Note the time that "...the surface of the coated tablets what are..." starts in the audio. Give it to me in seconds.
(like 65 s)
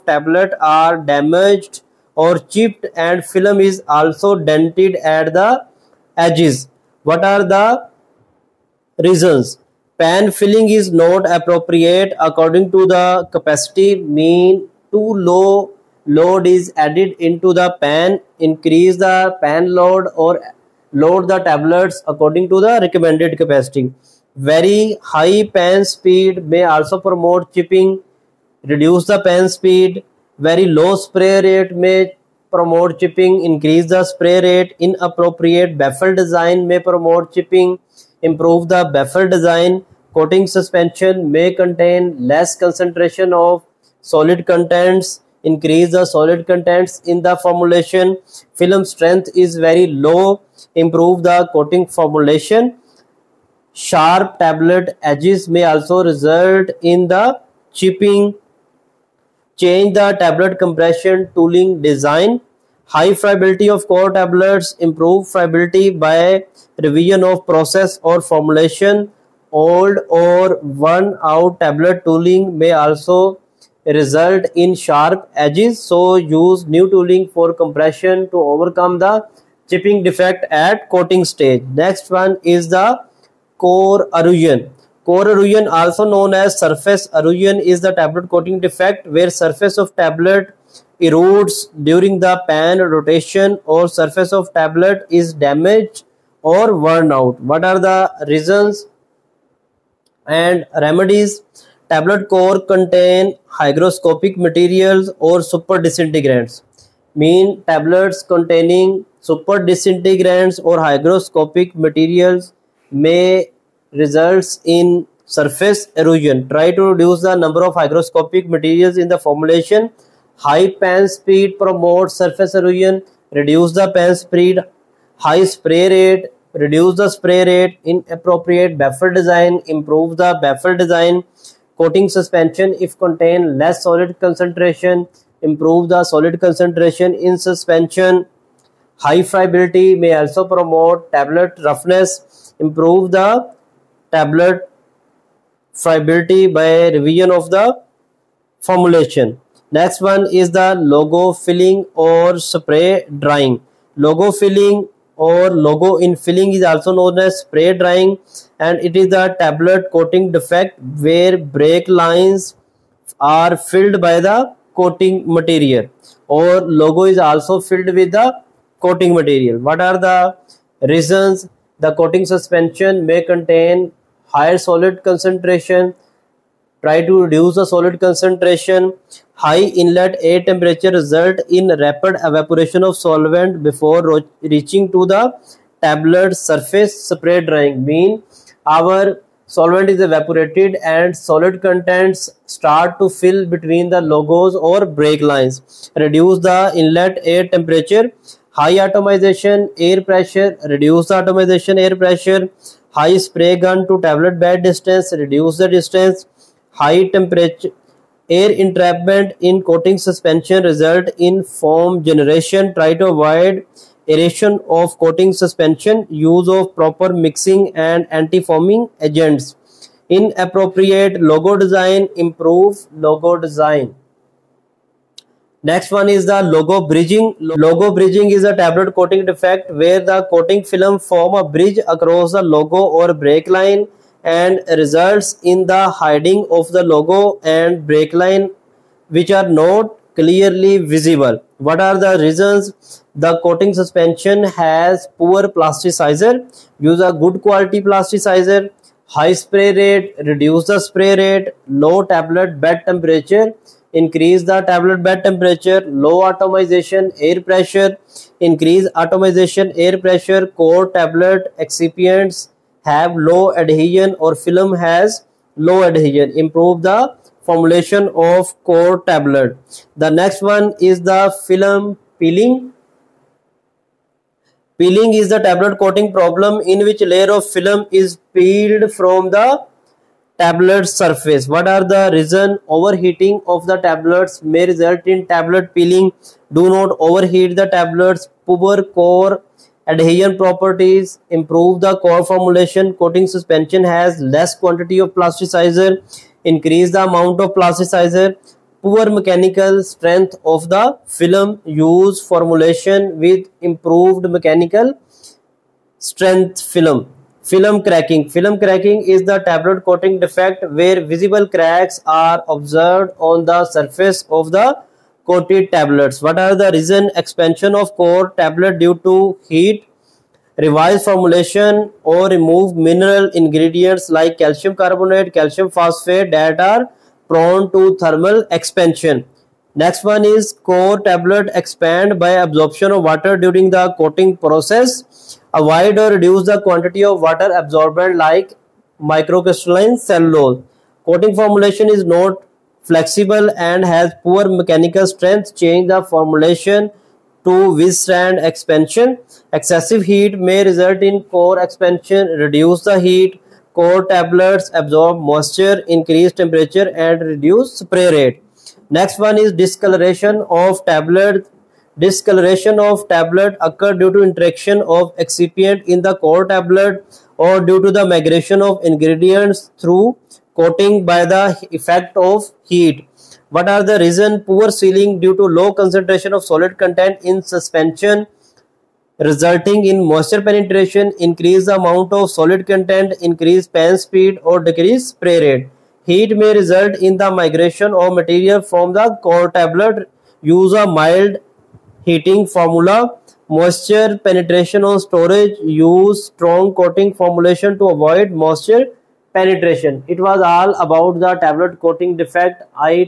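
313 s.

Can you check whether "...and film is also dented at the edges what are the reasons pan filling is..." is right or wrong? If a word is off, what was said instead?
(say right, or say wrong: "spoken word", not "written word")
right.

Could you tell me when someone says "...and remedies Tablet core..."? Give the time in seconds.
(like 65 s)
100 s.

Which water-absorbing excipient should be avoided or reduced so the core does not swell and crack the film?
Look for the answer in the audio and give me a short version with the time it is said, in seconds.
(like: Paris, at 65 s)
Microcrystalline cellulose, at 339 s.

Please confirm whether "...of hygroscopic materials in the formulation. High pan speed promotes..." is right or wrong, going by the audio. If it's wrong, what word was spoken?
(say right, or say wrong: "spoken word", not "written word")
right.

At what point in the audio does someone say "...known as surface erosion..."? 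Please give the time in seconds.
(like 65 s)
86 s.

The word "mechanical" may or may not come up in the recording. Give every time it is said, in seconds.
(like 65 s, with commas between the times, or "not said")
299 s, 304 s, 344 s.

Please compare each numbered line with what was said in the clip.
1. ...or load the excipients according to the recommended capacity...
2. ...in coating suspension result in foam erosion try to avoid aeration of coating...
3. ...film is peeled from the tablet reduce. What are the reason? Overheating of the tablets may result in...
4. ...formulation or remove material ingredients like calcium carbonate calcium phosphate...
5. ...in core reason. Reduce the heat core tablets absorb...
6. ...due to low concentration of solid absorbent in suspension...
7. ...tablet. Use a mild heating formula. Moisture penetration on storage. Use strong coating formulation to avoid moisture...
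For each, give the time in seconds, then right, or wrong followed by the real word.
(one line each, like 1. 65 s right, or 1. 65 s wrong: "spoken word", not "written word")
1. 20 s wrong: "tablets", not "excipients"
2. 209 s wrong: "generation", not "erosion"
3. 277 s wrong: "surface", not "reduce"
4. 321 s wrong: "mineral", not "material"
5. 351 s wrong: "expansion", not "reason"
6. 375 s wrong: "content", not "absorbent"
7. 389 s right.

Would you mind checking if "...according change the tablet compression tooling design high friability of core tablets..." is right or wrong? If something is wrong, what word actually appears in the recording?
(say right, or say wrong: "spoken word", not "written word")
wrong: "chipping", not "according".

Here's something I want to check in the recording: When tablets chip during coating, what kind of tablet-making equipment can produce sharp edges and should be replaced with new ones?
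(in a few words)
Old or worn out tablet tooling.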